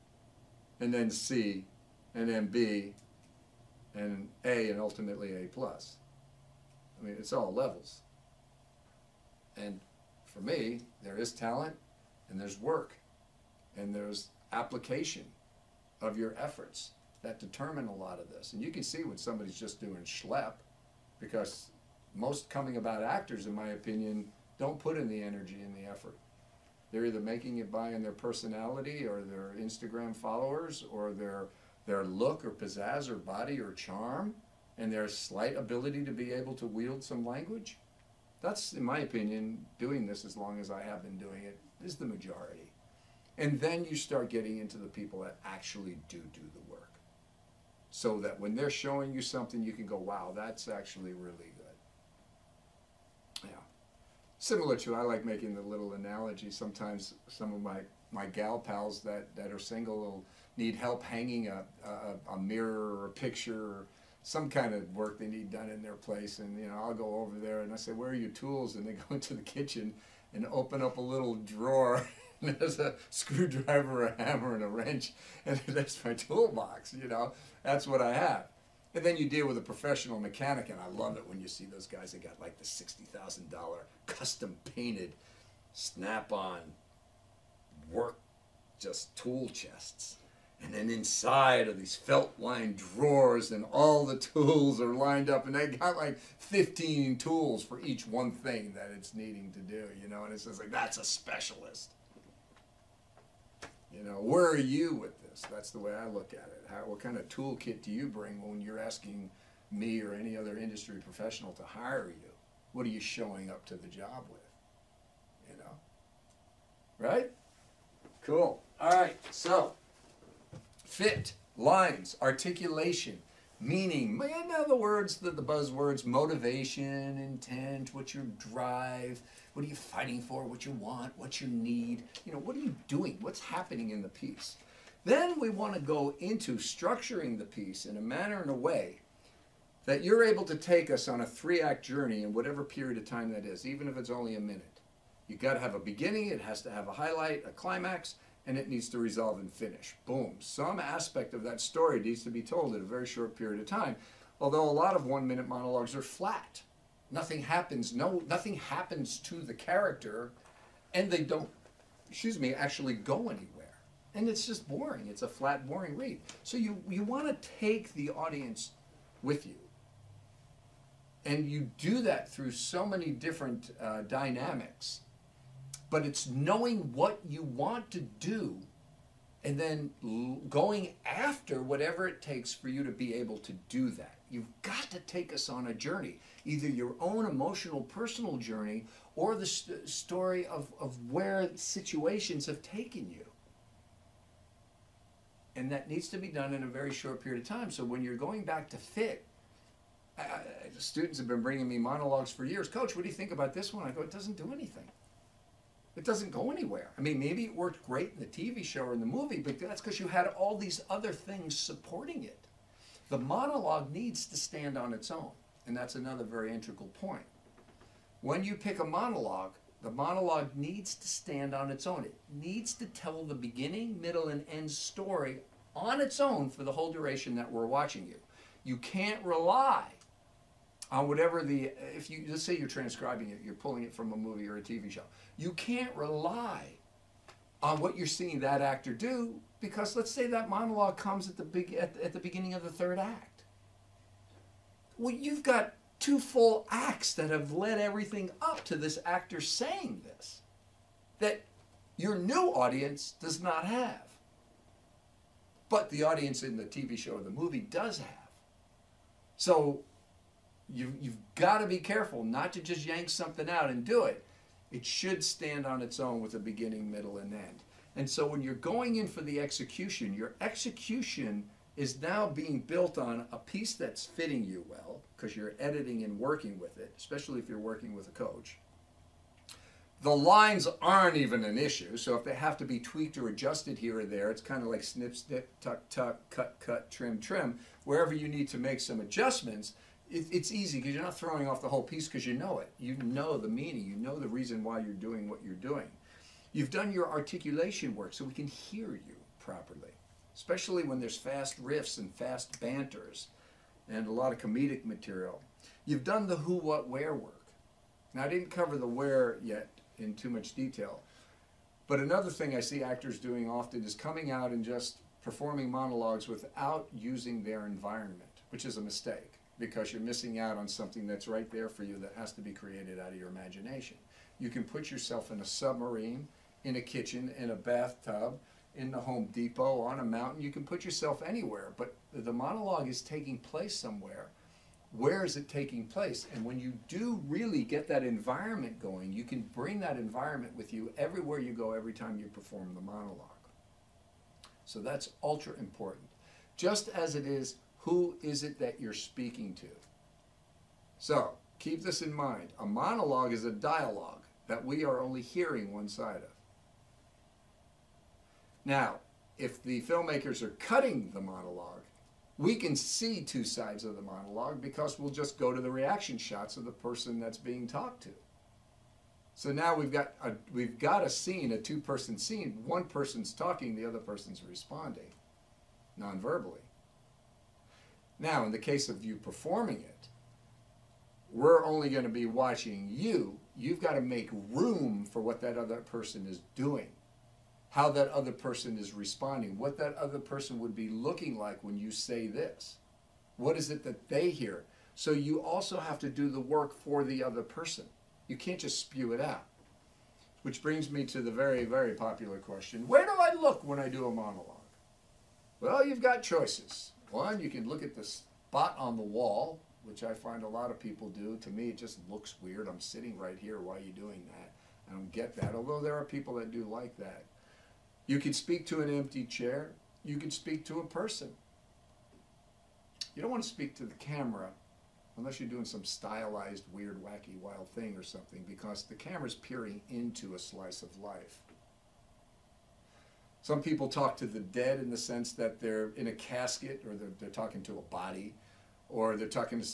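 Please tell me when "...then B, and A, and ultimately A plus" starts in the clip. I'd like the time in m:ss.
0:02.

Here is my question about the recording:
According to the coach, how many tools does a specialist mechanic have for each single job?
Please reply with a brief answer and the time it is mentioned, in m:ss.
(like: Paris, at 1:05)
15, at 1:36.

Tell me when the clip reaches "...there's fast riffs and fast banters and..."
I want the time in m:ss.
5:00.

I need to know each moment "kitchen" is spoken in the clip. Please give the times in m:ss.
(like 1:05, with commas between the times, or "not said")
1:09, 5:26.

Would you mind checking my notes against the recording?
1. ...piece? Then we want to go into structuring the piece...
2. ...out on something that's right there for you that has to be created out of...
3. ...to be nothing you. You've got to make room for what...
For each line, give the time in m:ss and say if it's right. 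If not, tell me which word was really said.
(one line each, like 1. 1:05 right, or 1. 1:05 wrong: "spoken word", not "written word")
1. 2:14 right
2. 5:20 right
3. 6:22 wrong: "watching", not "nothing".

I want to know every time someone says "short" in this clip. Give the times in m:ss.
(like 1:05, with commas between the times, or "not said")
2:33, 3:16.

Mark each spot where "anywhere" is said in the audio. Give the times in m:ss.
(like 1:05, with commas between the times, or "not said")
2:43, 3:26, 5:31.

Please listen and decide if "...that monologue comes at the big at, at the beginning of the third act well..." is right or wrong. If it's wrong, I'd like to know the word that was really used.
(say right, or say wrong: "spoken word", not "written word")
right.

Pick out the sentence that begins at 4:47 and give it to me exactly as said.
Wherever you need to make some adjustments, it, it's easy because you're not throwing off the whole piece because you know it.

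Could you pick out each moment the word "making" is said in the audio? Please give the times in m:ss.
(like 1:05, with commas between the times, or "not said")
0:27, 0:55.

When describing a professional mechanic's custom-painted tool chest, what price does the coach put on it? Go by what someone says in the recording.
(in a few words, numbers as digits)
$60,000.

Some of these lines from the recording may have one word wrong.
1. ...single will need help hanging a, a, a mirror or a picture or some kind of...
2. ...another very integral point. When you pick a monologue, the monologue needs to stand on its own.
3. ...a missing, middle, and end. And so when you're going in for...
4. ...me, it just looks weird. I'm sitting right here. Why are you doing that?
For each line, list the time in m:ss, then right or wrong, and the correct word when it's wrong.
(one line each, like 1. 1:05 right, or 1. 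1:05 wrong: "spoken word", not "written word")
1. 0:59 right
2. 3:35 right
3. 4:26 wrong: "beginning", not "missing"
4. 6:51 right.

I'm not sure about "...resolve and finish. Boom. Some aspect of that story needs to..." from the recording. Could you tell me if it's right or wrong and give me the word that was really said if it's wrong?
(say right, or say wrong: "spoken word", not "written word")
right.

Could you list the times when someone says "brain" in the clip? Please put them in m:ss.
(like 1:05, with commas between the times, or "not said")
not said.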